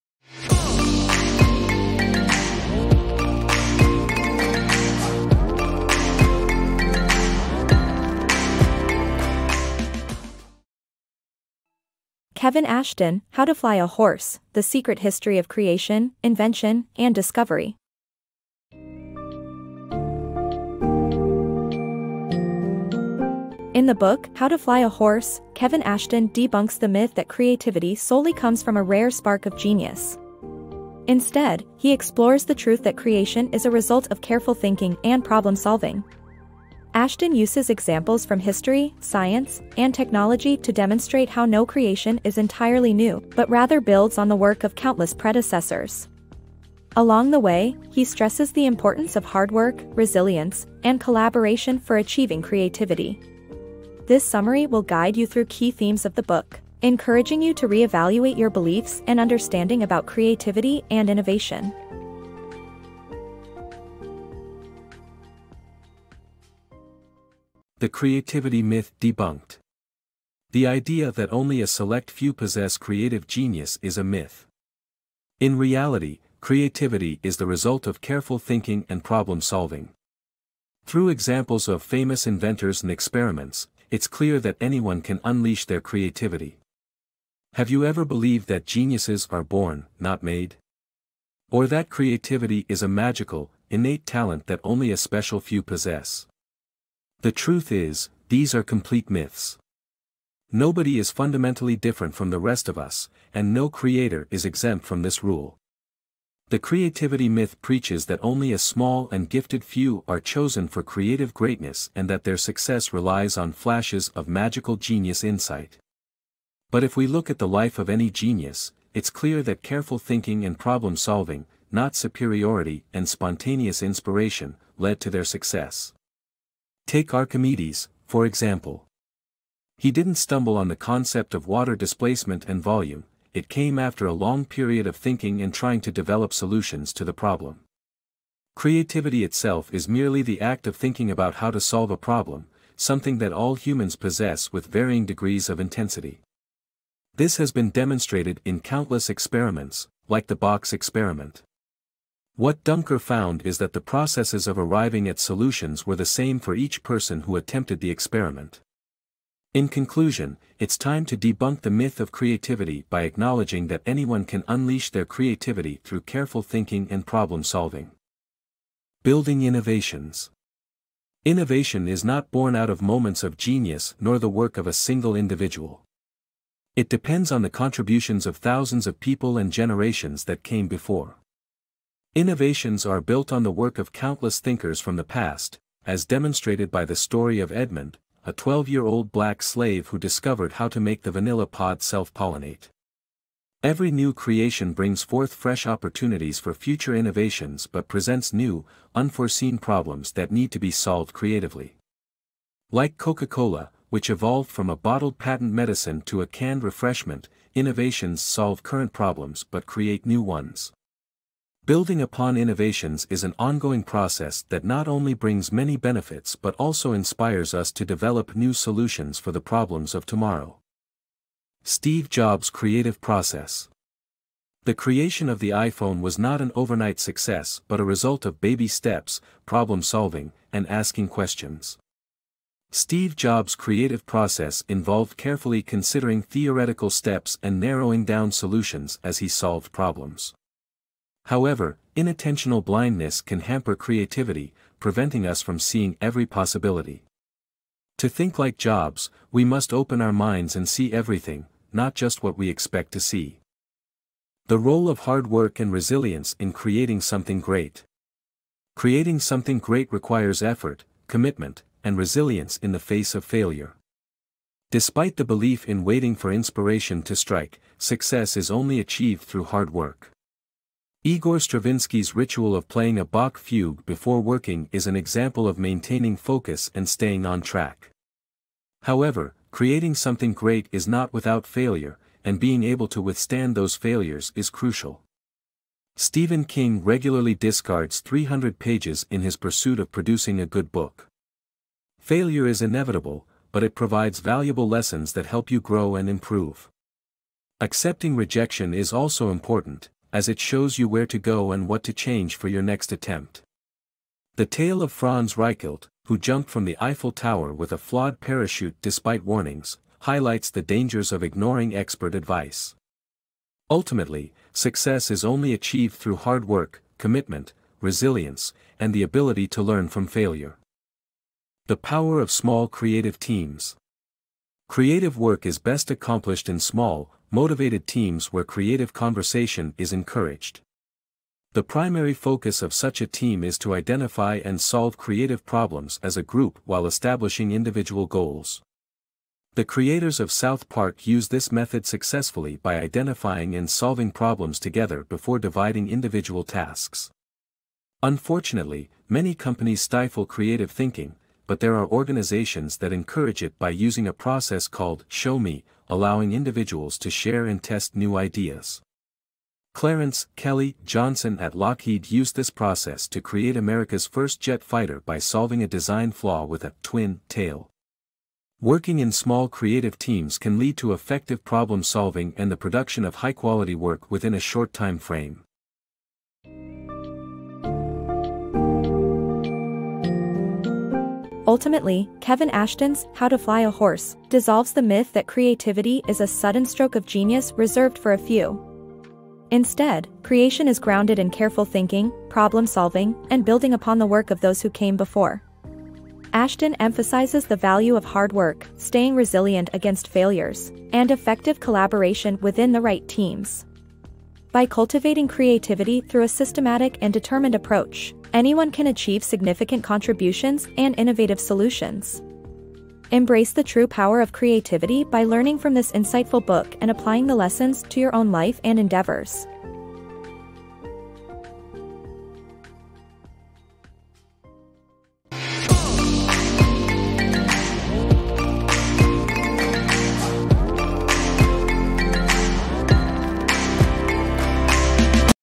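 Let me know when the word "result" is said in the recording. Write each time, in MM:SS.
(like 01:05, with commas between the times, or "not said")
00:33, 01:17, 03:47.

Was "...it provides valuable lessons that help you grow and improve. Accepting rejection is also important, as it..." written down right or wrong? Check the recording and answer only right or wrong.
right.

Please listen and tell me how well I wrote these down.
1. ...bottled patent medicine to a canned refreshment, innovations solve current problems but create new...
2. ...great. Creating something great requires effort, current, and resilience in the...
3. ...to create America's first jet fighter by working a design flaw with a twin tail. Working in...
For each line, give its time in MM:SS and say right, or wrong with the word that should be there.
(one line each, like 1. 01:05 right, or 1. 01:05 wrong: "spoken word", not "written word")
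1. 03:24 right
2. 04:17 wrong: "commitment", not "current"
3. 06:03 wrong: "solving", not "working".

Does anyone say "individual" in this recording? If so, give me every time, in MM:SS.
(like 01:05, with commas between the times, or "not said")
02:55, 05:37, 05:45, 05:56.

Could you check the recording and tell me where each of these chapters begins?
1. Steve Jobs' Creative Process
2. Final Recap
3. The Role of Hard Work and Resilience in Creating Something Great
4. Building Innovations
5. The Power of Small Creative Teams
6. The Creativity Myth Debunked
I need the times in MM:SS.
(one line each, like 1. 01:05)
1. 03:42
2. 06:17
3. 04:15
4. 02:49
5. 05:22
6. 01:08.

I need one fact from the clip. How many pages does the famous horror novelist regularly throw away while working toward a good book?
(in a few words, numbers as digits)
300.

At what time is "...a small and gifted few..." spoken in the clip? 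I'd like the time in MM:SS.
01:48.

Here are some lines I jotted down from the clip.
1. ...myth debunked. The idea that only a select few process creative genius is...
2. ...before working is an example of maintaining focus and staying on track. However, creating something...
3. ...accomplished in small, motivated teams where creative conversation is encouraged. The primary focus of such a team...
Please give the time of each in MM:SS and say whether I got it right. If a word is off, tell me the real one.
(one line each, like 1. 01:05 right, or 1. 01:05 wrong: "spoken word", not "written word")
1. 01:08 wrong: "possess", not "process"
2. 04:33 right
3. 05:25 right.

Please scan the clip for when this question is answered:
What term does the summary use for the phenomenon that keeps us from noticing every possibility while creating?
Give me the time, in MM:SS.
04:01.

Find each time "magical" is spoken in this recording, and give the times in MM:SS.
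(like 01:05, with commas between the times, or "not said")
01:32, 01:54.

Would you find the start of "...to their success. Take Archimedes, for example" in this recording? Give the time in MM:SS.
02:05.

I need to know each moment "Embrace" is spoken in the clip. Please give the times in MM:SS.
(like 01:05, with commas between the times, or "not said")
06:53.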